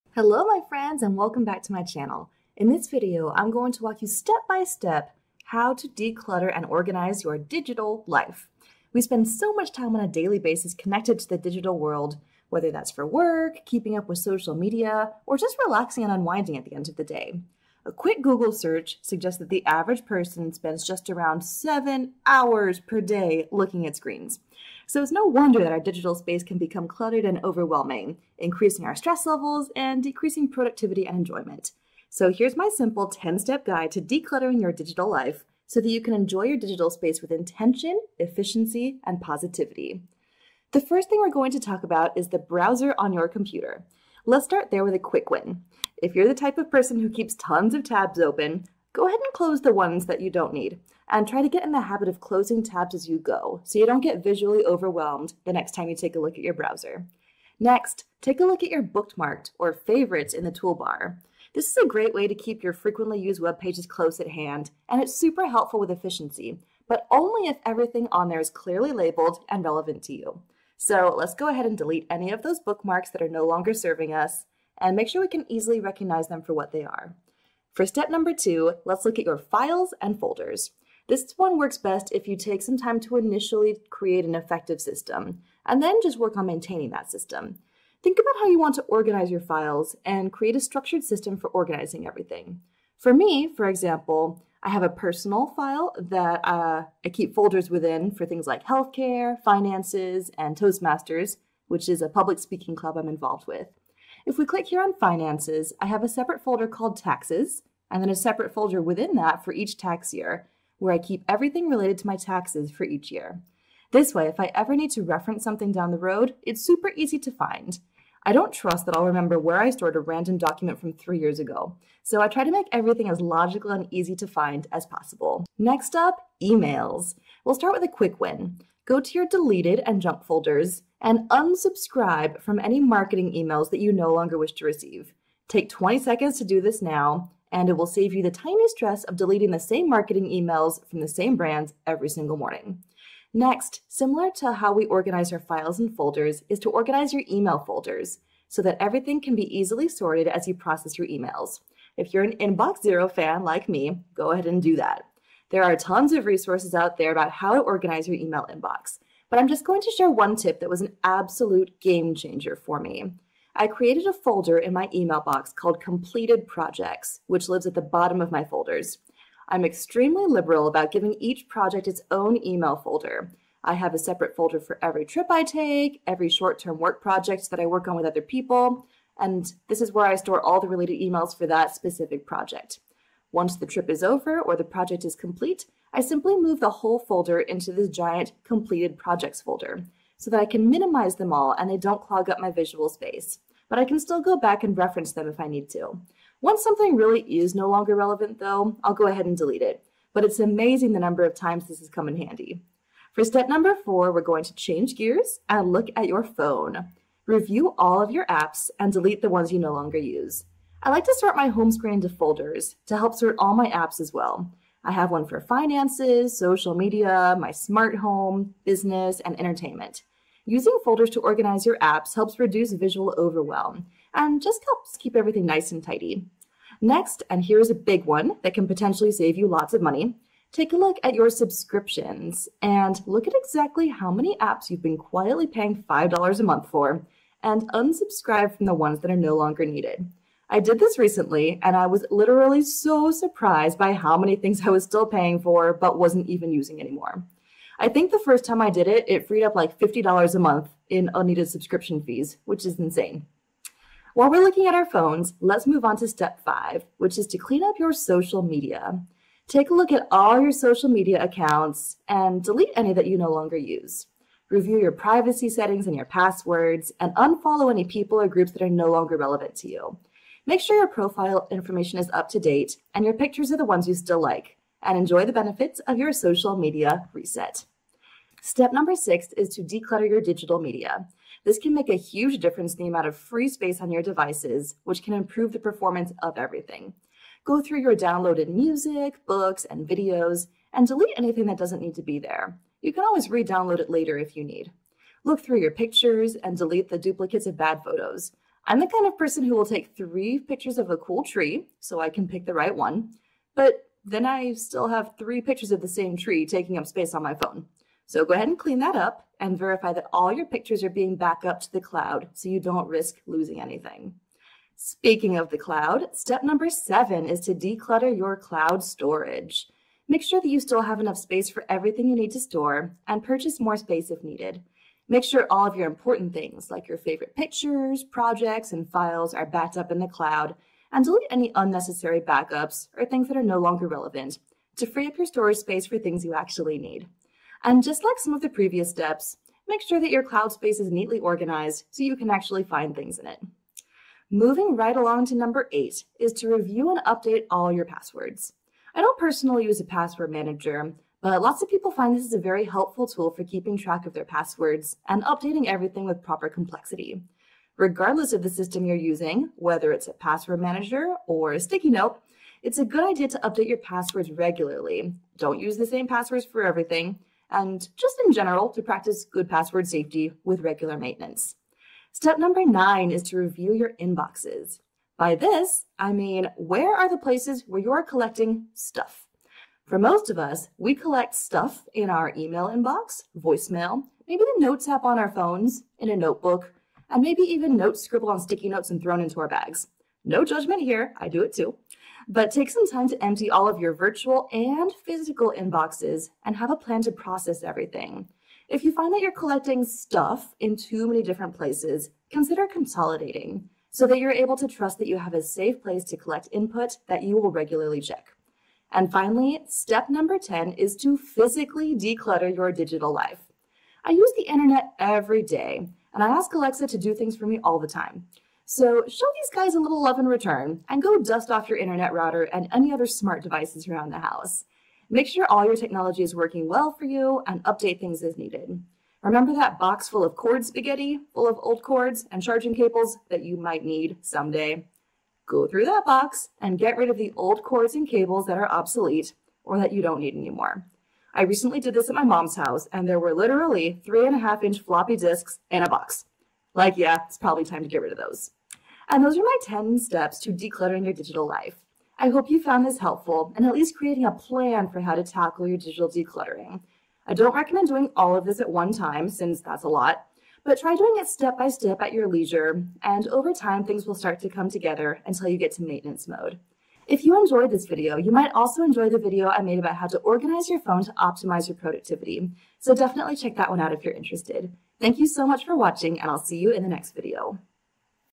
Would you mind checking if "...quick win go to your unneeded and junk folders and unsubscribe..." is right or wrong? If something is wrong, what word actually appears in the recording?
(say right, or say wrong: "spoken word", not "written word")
wrong: "deleted", not "unneeded".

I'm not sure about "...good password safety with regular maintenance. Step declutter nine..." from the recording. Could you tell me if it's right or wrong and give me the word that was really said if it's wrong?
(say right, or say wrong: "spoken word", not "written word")
wrong: "number", not "declutter".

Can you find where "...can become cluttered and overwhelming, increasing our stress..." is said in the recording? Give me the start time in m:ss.
0:26.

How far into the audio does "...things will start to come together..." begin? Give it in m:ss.
7:43.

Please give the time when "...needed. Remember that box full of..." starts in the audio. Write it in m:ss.
7:08.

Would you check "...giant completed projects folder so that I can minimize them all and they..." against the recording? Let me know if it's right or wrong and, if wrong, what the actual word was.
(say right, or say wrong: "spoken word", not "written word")
right.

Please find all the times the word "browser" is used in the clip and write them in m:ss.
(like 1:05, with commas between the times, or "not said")
0:42, 0:56.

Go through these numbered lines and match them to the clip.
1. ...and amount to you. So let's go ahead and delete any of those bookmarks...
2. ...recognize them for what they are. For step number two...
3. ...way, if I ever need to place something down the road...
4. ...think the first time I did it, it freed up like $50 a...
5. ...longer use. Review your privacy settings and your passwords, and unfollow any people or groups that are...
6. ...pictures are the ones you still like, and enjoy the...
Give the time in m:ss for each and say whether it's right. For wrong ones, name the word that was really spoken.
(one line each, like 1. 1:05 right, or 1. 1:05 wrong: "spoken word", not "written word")
1. 1:09 wrong: "relevant", not "amount"
2. 1:15 right
3. 1:54 wrong: "reference", not "place"
4. 4:07 right
5. 4:23 right
6. 4:33 right.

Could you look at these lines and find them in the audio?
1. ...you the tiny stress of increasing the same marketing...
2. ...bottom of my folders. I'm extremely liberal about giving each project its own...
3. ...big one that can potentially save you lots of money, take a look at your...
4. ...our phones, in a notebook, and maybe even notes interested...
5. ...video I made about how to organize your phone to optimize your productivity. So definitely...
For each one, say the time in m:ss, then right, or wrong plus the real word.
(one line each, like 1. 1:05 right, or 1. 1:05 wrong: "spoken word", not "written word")
1. 2:18 wrong: "deleting", not "increasing"
2. 2:47 right
3. 3:47 right
4. 6:25 wrong: "scribbled", not "interested"
5. 7:49 right.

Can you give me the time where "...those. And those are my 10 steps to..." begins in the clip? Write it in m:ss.
7:28.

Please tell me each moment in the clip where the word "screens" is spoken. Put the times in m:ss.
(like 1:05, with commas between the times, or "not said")
0:23, 3:31.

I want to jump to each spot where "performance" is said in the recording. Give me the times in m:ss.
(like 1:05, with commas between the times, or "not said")
4:45.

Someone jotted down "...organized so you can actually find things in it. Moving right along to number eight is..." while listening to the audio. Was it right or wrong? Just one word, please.
right.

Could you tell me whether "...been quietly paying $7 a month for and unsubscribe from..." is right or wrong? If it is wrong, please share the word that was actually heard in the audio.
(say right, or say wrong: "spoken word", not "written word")
wrong: "5", not "7".